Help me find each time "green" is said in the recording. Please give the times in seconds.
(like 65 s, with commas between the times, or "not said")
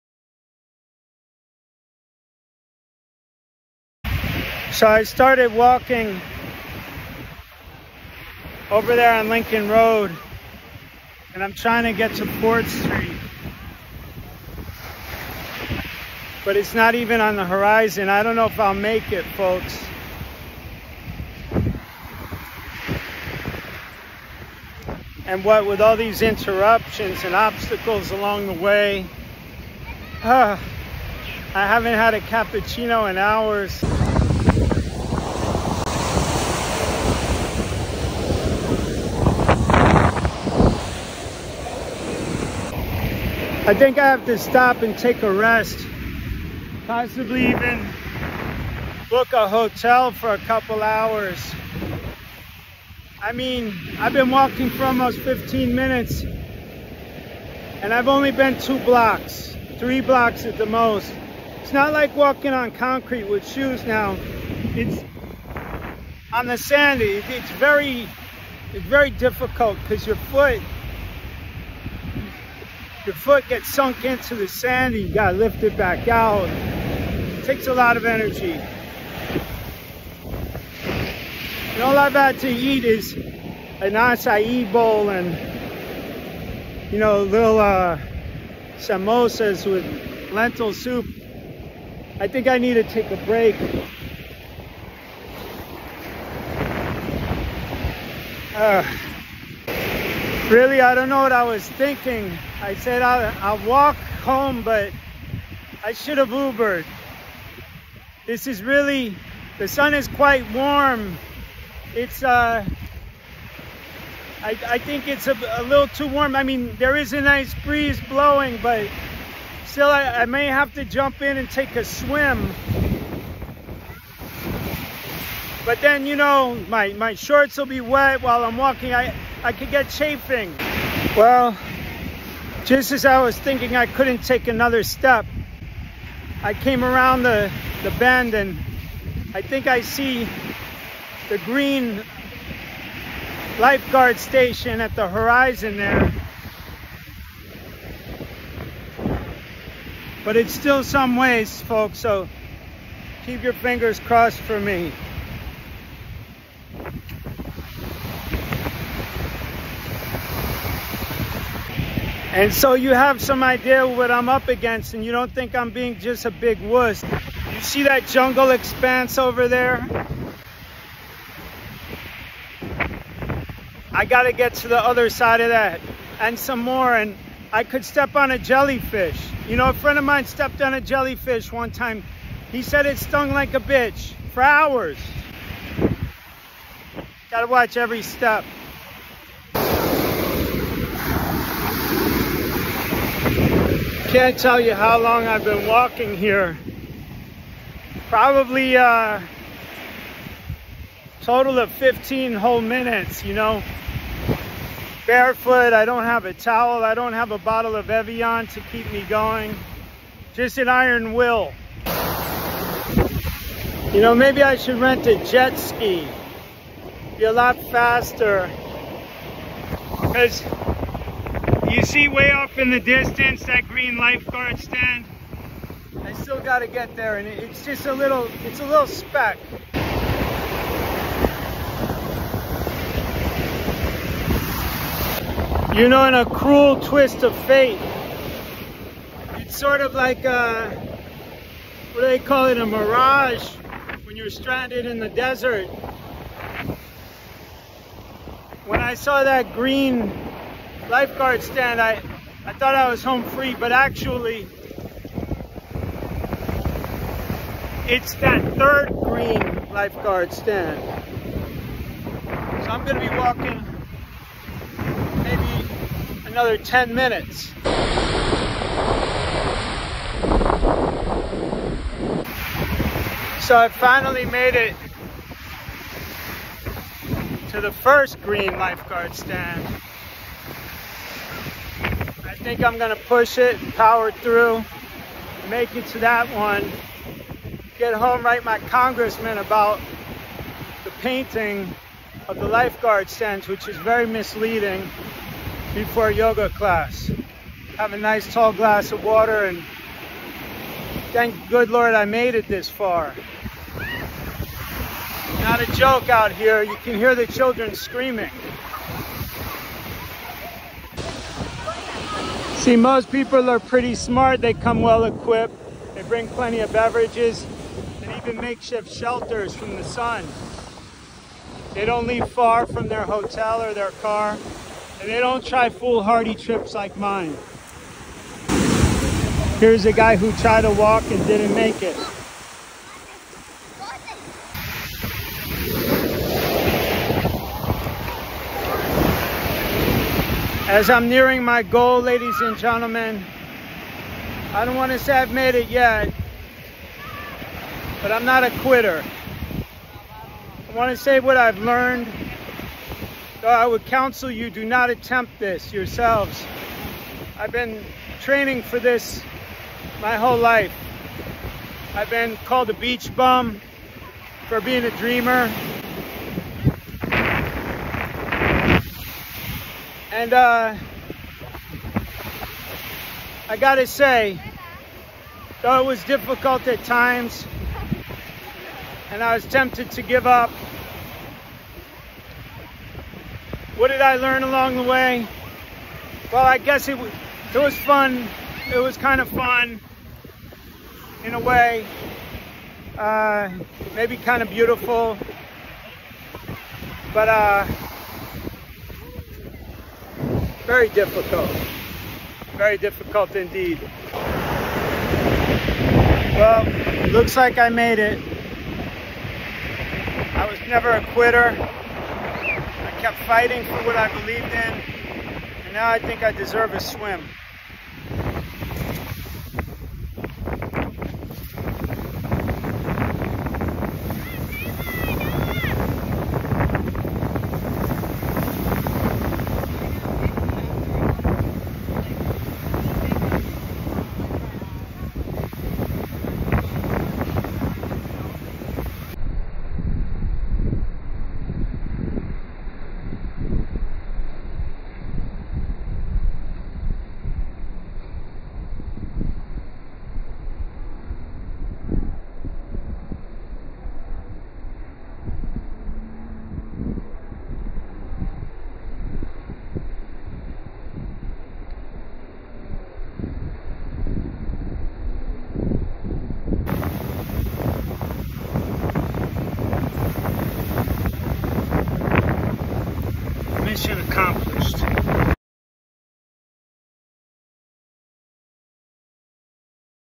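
141 s, 223 s, 249 s, 259 s, 278 s.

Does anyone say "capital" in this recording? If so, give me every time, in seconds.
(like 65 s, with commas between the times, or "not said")
not said.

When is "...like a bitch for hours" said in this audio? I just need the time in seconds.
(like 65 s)
183 s.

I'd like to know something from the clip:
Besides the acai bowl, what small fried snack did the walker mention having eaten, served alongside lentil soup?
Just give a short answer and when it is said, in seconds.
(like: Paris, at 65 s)
samosas, at 88 s.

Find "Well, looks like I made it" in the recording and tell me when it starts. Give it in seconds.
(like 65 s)
406 s.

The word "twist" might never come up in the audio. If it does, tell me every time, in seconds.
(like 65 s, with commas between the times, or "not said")
236 s.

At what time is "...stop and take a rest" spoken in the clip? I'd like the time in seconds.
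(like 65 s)
44 s.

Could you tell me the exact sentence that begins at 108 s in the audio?
This is really, the sun is quite warm.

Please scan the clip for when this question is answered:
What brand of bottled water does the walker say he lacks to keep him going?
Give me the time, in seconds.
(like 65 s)
207 s.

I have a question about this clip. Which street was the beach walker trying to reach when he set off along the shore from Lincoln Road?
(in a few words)
Port Street.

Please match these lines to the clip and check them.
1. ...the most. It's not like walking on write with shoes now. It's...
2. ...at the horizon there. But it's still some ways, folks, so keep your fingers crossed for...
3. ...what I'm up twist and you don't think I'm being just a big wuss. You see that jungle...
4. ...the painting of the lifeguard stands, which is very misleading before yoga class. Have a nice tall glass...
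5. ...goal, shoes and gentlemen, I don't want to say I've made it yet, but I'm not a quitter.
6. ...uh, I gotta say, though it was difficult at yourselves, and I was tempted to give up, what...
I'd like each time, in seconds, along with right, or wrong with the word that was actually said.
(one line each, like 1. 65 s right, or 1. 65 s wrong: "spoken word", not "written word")
1. 60 s wrong: "concrete", not "write"
2. 144 s right
3. 163 s wrong: "against", not "twist"
4. 290 s right
5. 341 s wrong: "ladies", not "shoes"
6. 370 s wrong: "times", not "yourselves".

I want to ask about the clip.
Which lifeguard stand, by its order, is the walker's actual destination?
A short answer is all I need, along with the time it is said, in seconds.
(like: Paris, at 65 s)
third, at 258 s.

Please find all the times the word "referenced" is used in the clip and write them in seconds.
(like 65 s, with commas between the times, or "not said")
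not said.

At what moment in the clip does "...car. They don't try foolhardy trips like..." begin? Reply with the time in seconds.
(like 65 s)
324 s.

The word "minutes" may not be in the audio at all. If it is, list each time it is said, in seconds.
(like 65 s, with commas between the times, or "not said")
55 s, 202 s, 266 s.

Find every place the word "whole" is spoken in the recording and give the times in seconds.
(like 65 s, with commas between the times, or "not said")
202 s, 360 s.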